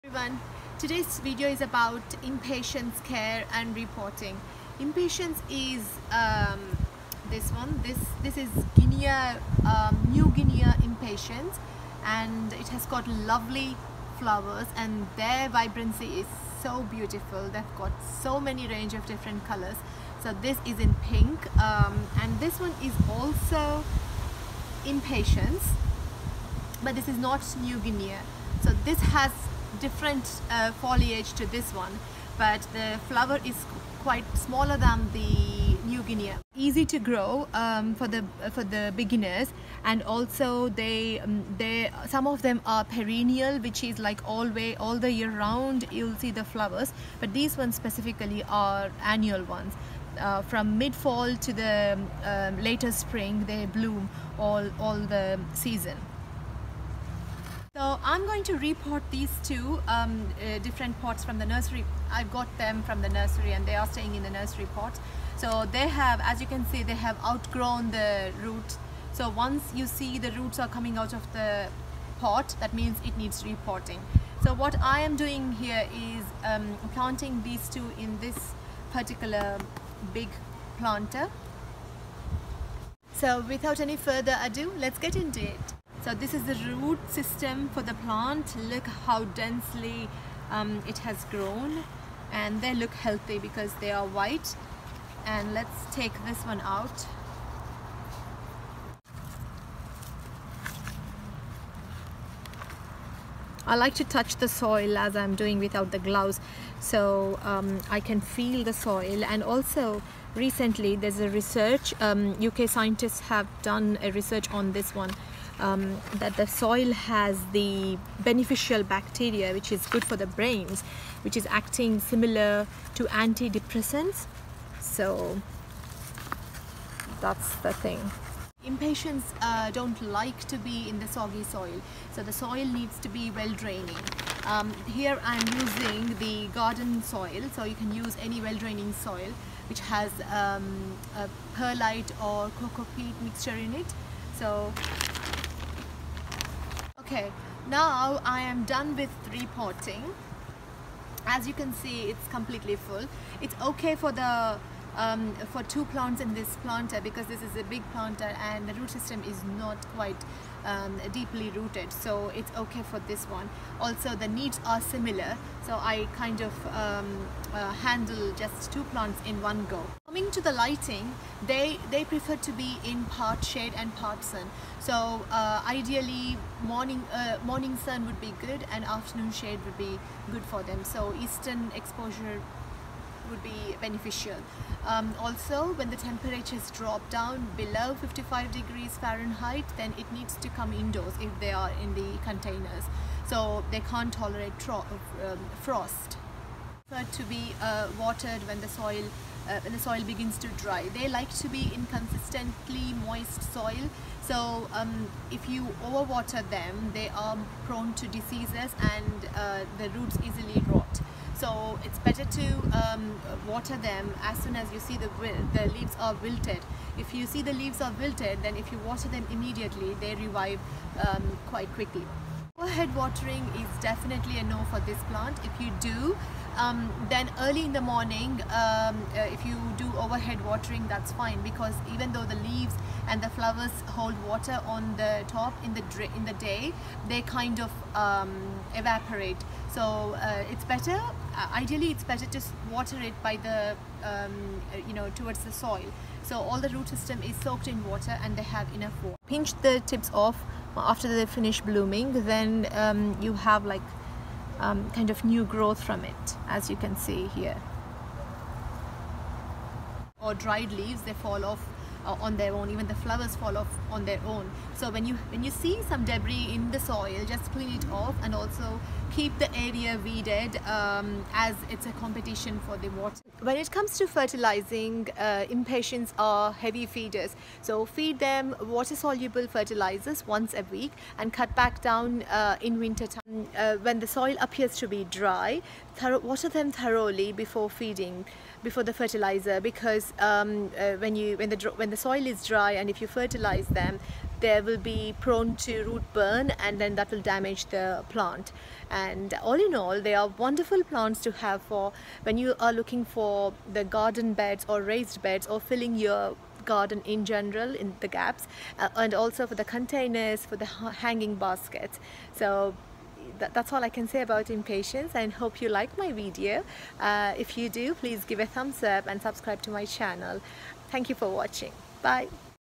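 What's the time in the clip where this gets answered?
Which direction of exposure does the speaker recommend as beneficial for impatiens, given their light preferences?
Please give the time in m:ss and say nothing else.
3:01.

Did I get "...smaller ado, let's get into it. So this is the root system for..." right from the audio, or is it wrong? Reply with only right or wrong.
wrong.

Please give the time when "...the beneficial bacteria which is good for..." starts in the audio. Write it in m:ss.
1:57.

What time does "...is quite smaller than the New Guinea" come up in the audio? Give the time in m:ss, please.
0:33.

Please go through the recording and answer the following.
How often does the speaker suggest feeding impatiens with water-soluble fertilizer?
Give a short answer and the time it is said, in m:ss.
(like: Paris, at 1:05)
Once a week, at 4:40.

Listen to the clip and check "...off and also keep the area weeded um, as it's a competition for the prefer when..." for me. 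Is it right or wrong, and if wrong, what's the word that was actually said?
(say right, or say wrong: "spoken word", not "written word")
wrong: "water", not "prefer".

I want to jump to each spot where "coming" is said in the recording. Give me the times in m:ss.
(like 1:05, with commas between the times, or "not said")
1:10, 2:50.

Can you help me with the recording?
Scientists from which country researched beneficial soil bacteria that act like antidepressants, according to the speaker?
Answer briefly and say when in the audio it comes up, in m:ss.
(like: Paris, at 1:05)
UK, at 1:52.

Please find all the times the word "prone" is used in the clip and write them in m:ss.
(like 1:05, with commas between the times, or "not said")
3:27, 4:55.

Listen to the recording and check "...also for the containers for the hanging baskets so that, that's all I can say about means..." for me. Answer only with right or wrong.
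wrong.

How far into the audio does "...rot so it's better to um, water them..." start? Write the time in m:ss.
3:30.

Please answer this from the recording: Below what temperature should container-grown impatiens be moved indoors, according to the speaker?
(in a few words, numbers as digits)
55 degrees Fahrenheit.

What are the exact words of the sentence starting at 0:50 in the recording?
Uh, from mid-fall to the um, later spring they bloom all all the season.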